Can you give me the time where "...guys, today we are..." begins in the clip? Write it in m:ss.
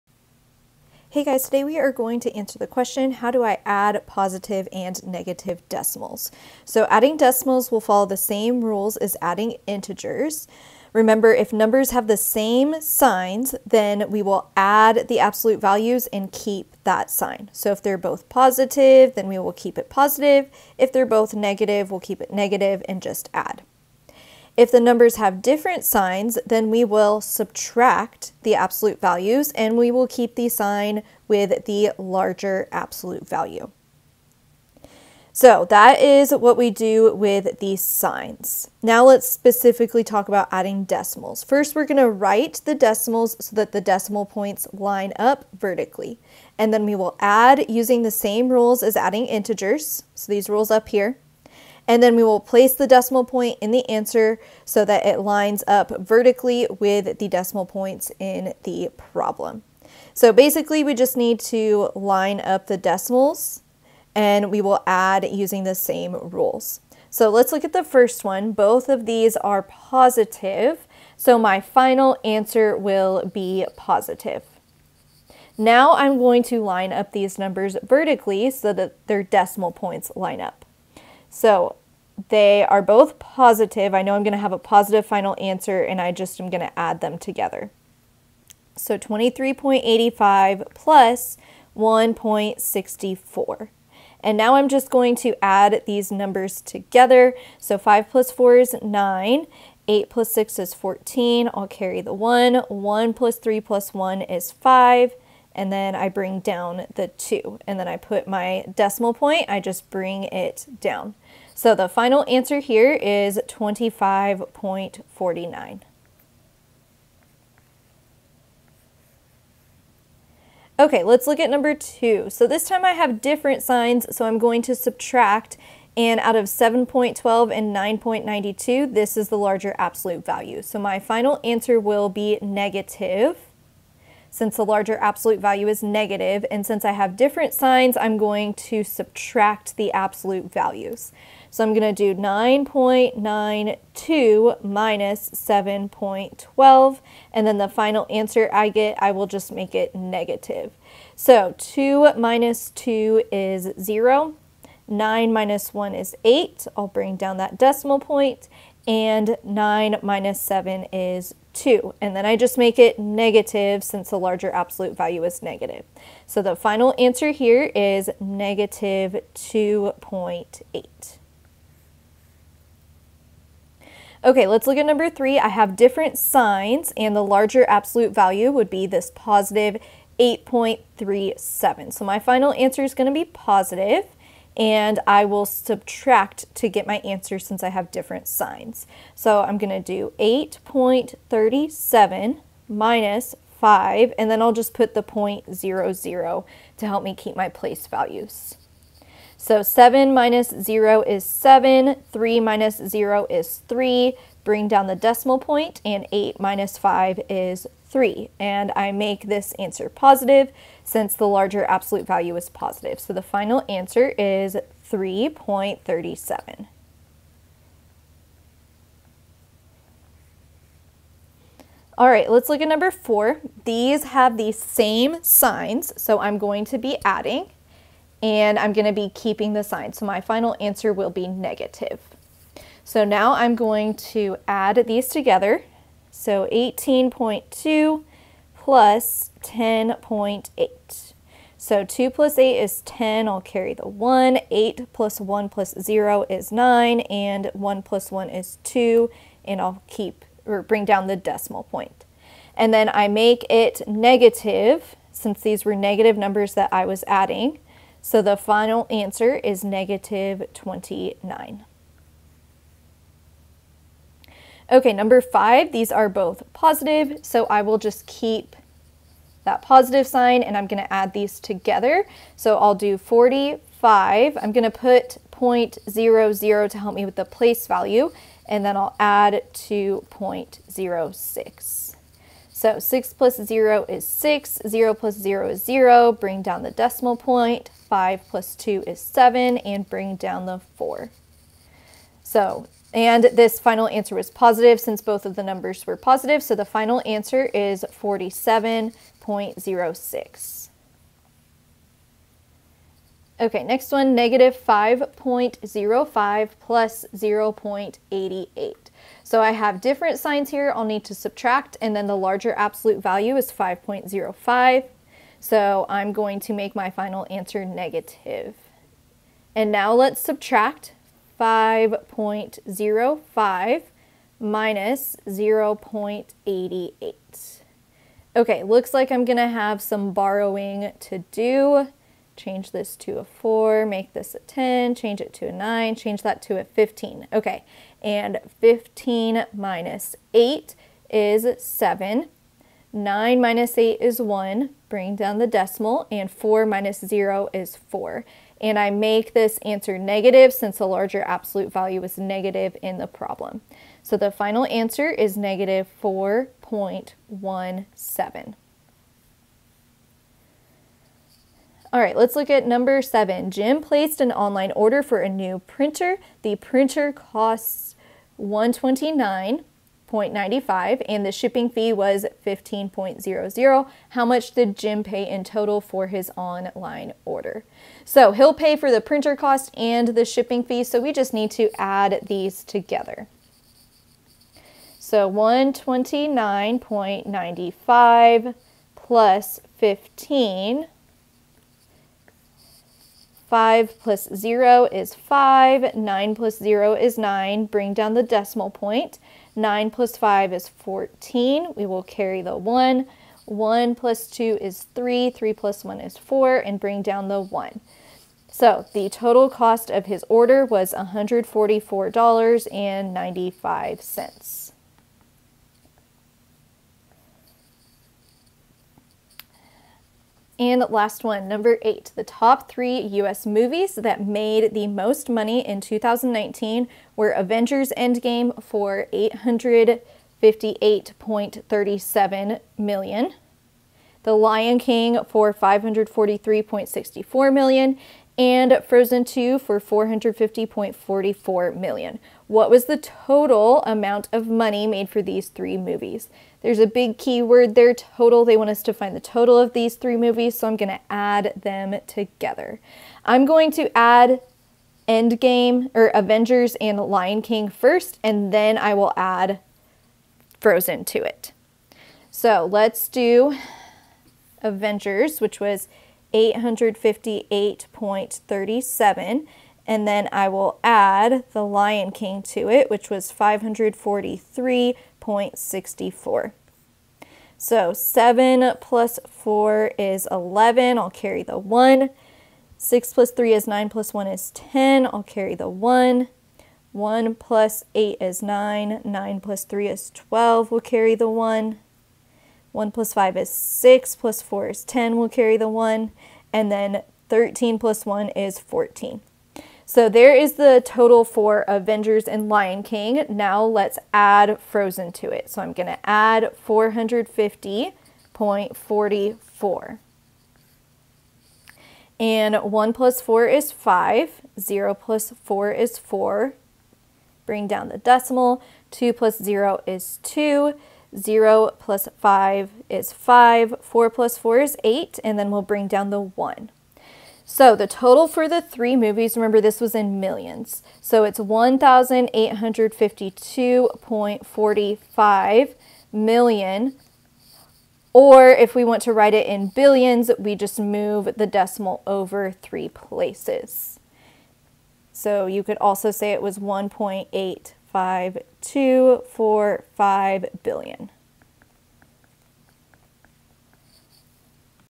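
0:01.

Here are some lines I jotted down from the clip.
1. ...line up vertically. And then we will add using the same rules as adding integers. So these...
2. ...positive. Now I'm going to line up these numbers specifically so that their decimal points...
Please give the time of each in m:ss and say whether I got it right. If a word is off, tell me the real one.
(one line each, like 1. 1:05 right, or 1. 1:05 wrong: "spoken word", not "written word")
1. 0:44 right
2. 1:13 wrong: "vertically", not "specifically".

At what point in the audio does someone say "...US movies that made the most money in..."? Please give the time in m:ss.
7:02.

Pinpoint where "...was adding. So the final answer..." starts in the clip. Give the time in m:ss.
4:16.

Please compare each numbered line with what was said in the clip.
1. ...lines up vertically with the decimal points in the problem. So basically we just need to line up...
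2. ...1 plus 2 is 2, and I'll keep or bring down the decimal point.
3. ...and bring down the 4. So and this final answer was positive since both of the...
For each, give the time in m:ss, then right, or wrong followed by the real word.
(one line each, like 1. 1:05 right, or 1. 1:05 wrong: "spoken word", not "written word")
1. 0:55 right
2. 4:07 wrong: "1", not "2"
3. 4:49 right.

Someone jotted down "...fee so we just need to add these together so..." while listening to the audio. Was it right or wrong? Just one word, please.
right.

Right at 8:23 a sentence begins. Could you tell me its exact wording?
Now let's add Frozen to it.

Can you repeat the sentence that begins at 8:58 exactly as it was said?
Or if we want to write it in billions, we just move the decimal over three places.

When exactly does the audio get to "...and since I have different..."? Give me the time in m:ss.
2:16.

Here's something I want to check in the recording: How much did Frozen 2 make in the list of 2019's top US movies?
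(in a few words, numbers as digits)
450.44 million.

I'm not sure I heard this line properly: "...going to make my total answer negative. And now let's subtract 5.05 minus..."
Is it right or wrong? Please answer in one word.
wrong.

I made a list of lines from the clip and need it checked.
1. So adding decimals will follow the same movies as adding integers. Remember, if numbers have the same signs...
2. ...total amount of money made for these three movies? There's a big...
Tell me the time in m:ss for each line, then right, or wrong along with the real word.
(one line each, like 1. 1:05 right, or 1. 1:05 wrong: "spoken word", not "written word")
1. 0:06 wrong: "rules", not "movies"
2. 7:22 right.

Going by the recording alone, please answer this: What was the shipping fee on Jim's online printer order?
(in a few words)
15.00.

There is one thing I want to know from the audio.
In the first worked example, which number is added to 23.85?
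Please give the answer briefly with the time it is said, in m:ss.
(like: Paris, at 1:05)
1.64, at 1:31.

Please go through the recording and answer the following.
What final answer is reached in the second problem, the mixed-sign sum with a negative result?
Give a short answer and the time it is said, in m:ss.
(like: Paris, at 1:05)
-2.8, at 2:48.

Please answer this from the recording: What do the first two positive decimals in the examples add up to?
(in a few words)
25.49.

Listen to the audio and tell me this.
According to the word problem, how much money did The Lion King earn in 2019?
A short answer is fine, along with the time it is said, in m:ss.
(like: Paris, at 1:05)
543.64 million, at 7:15.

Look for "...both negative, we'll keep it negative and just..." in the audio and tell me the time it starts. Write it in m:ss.
0:21.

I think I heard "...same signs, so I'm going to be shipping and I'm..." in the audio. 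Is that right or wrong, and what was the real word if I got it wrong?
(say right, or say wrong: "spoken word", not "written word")
wrong: "adding", not "shipping".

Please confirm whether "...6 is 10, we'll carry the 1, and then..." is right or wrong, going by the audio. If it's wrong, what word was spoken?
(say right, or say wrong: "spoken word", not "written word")
wrong: "4", not "6".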